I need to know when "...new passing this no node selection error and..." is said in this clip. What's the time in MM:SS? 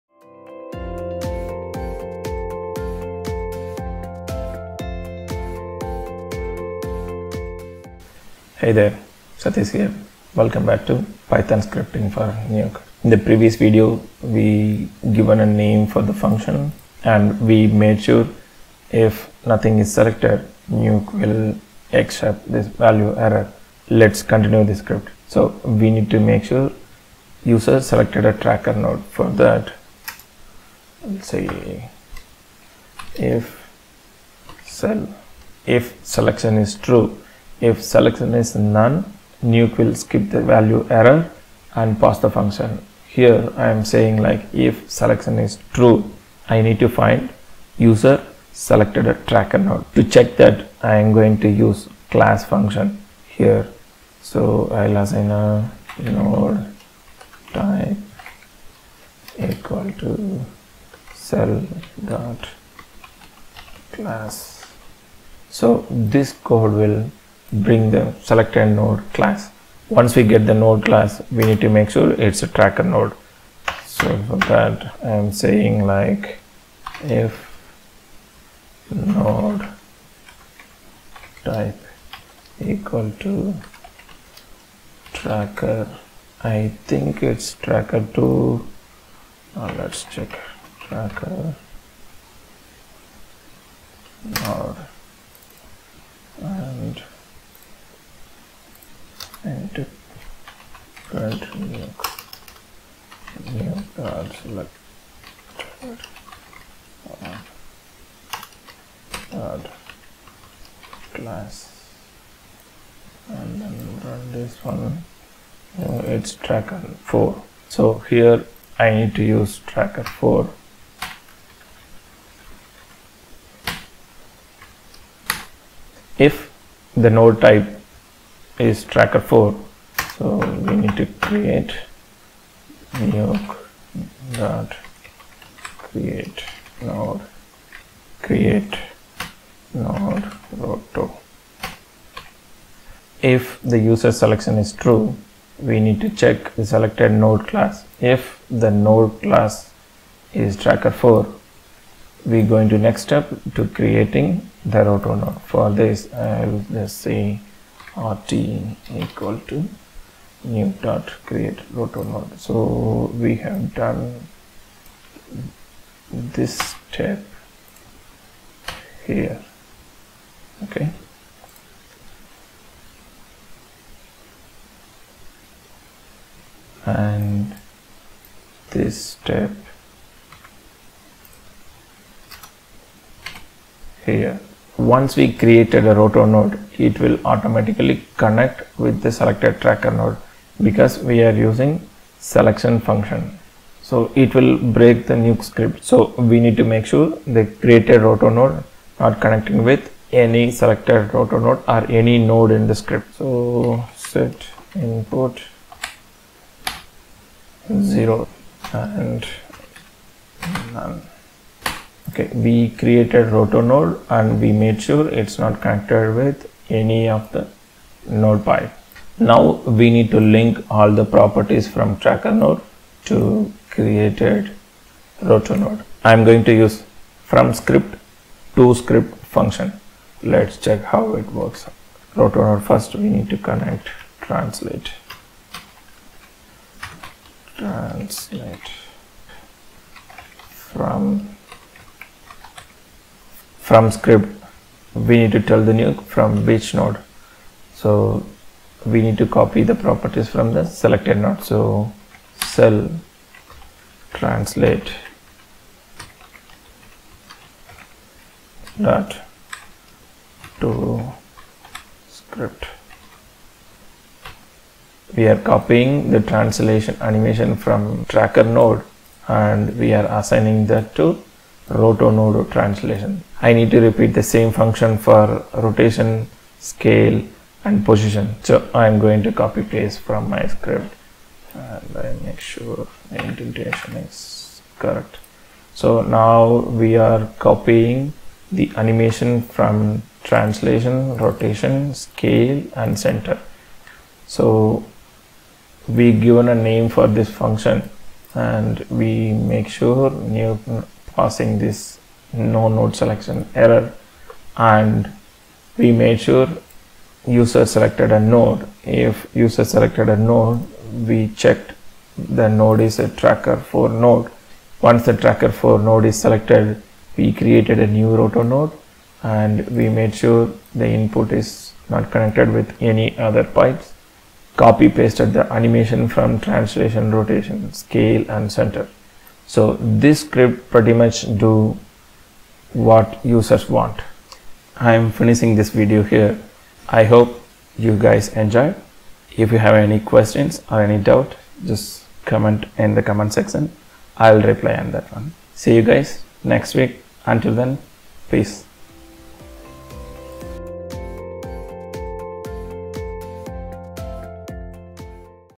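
05:00.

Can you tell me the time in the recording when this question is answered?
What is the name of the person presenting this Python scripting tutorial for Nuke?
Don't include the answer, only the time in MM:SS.
00:09.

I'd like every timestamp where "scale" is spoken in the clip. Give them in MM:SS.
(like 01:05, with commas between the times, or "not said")
04:36, 04:51, 05:27.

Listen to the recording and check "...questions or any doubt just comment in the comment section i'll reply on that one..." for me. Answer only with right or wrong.
right.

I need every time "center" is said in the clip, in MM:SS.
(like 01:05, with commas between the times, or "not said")
04:52, 05:28.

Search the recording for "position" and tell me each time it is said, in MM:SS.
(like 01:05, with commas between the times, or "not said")
04:37.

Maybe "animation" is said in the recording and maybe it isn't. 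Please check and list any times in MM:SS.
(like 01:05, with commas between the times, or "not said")
04:27, 04:48, 05:25.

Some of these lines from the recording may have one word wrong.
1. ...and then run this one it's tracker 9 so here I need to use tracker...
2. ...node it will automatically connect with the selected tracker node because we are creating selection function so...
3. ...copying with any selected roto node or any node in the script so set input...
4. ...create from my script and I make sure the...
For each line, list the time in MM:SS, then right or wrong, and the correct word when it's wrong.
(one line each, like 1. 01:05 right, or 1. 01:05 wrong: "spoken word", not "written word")
1. 01:53 wrong: "4", not "9"
2. 03:06 wrong: "using", not "creating"
3. 03:19 wrong: "connecting", not "copying"
4. 04:39 wrong: "paste", not "create".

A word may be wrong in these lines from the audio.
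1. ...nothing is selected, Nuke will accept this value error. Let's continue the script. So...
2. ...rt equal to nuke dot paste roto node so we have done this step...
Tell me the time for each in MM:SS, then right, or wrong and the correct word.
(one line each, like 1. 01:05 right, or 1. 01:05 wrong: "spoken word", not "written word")
1. 00:19 right
2. 02:37 wrong: "create", not "paste".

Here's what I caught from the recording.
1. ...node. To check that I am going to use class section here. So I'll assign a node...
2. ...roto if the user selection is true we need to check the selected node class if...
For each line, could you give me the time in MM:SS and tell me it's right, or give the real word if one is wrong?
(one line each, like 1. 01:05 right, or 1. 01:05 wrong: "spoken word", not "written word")
1. 00:49 wrong: "function", not "section"
2. 02:20 right.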